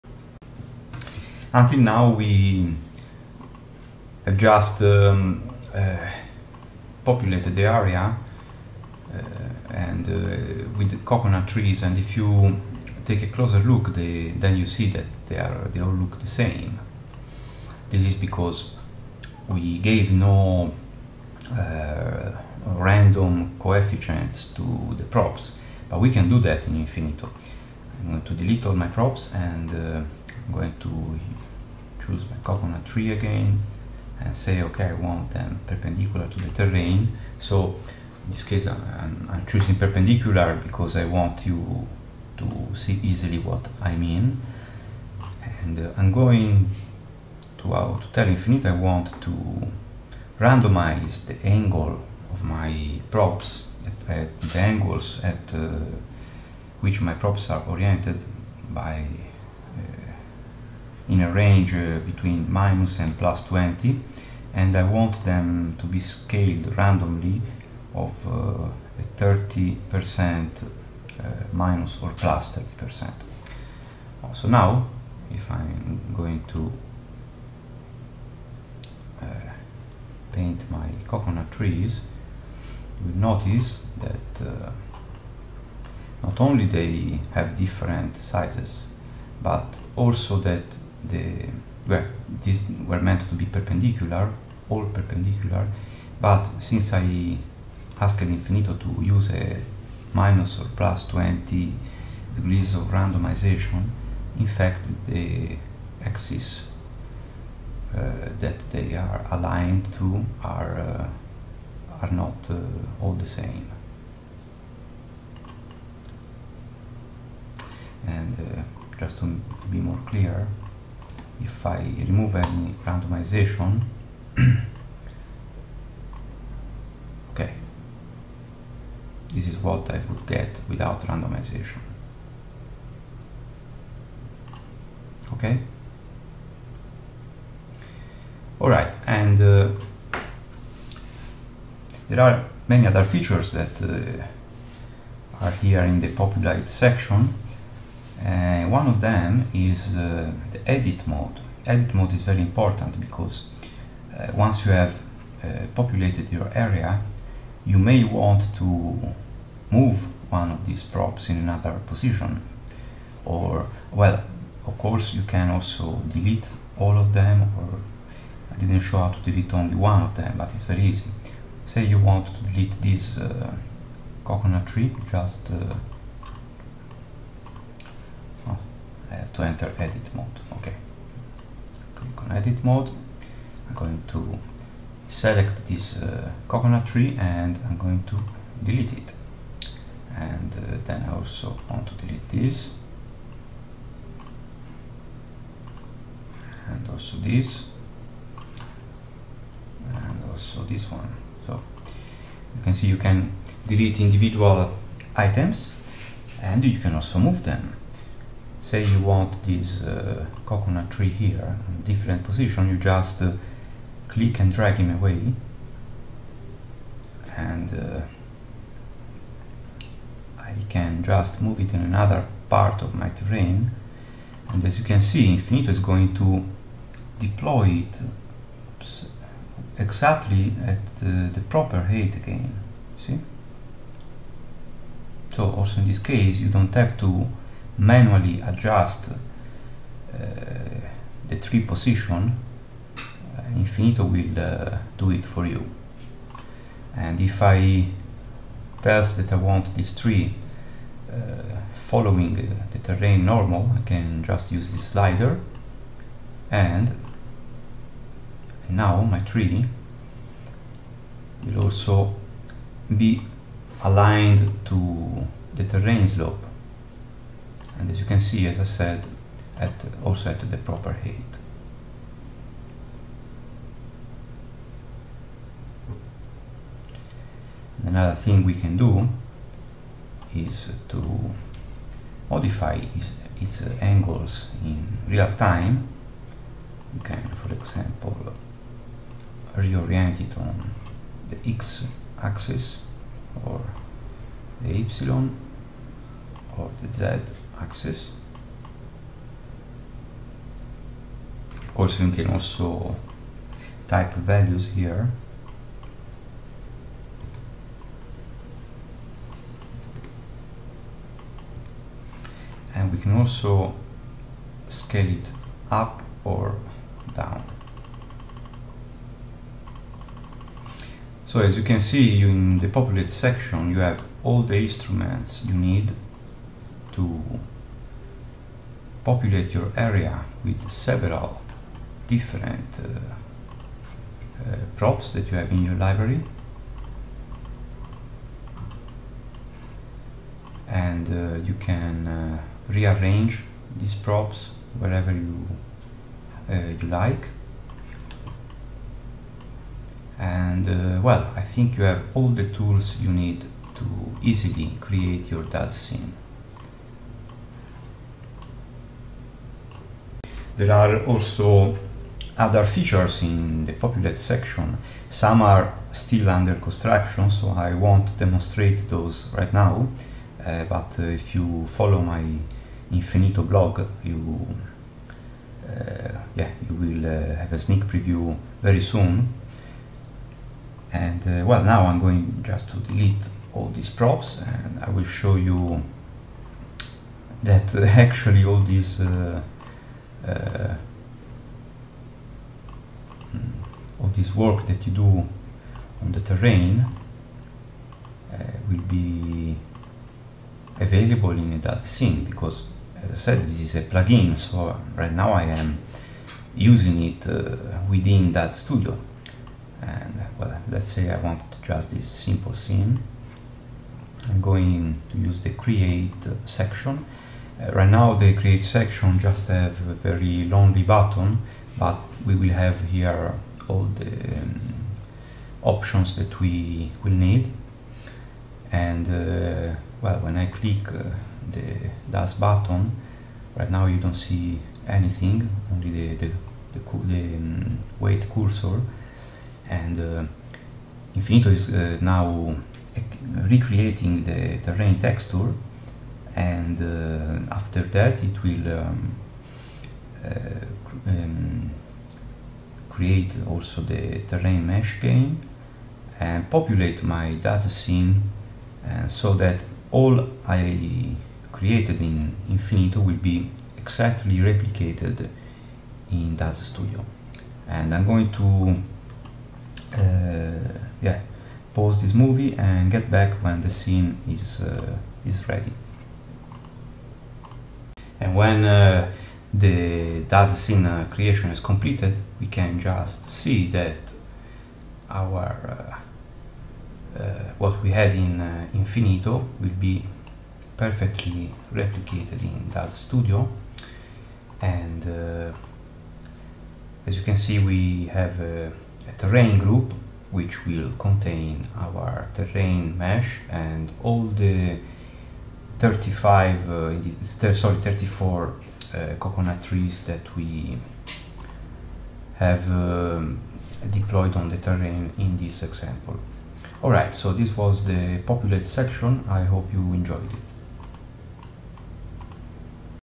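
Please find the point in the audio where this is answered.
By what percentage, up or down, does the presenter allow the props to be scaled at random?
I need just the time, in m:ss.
1:11.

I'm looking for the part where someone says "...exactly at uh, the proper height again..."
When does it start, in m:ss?
3:49.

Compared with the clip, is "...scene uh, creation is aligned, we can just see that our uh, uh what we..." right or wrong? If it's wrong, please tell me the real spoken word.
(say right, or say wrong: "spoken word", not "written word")
wrong: "completed", not "aligned".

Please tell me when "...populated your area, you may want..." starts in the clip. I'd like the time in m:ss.
2:35.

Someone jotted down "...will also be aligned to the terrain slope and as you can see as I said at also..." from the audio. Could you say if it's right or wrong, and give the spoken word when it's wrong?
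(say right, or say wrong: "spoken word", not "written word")
right.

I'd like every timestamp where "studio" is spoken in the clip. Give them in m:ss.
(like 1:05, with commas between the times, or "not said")
6:48, 7:46, 8:13.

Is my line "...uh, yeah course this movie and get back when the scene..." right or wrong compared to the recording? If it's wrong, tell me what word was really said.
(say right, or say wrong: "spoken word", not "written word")
wrong: "pause", not "course".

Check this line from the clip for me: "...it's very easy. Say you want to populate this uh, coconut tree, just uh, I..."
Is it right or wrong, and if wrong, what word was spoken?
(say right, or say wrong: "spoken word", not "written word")
wrong: "delete", not "populate".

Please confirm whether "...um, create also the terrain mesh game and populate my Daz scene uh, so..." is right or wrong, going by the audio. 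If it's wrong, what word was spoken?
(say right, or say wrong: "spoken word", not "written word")
right.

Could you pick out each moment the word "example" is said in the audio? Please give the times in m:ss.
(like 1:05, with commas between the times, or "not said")
4:47, 8:35.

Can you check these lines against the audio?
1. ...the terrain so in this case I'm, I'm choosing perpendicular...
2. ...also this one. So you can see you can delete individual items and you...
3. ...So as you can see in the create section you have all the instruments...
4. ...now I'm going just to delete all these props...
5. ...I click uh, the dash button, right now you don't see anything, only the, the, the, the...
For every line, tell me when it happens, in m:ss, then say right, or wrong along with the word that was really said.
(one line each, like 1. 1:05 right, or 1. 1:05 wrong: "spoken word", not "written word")
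1. 0:36 right
2. 3:20 right
3. 5:21 wrong: "populate", not "create"
4. 6:21 right
5. 7:10 right.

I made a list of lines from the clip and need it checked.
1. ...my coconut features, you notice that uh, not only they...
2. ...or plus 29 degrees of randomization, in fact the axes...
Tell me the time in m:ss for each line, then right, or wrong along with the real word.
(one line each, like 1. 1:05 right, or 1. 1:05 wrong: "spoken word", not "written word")
1. 1:20 wrong: "trees", not "features"
2. 1:40 wrong: "20", not "29".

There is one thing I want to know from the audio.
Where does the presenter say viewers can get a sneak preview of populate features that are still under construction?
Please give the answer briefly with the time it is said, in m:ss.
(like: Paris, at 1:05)
Infinito blog, at 6:12.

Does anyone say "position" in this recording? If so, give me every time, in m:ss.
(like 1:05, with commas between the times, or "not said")
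2:41, 3:32, 4:01.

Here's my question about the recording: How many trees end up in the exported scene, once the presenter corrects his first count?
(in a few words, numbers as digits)
34.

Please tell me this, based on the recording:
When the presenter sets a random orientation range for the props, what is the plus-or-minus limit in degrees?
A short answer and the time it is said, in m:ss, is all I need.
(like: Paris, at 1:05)
20, at 1:02.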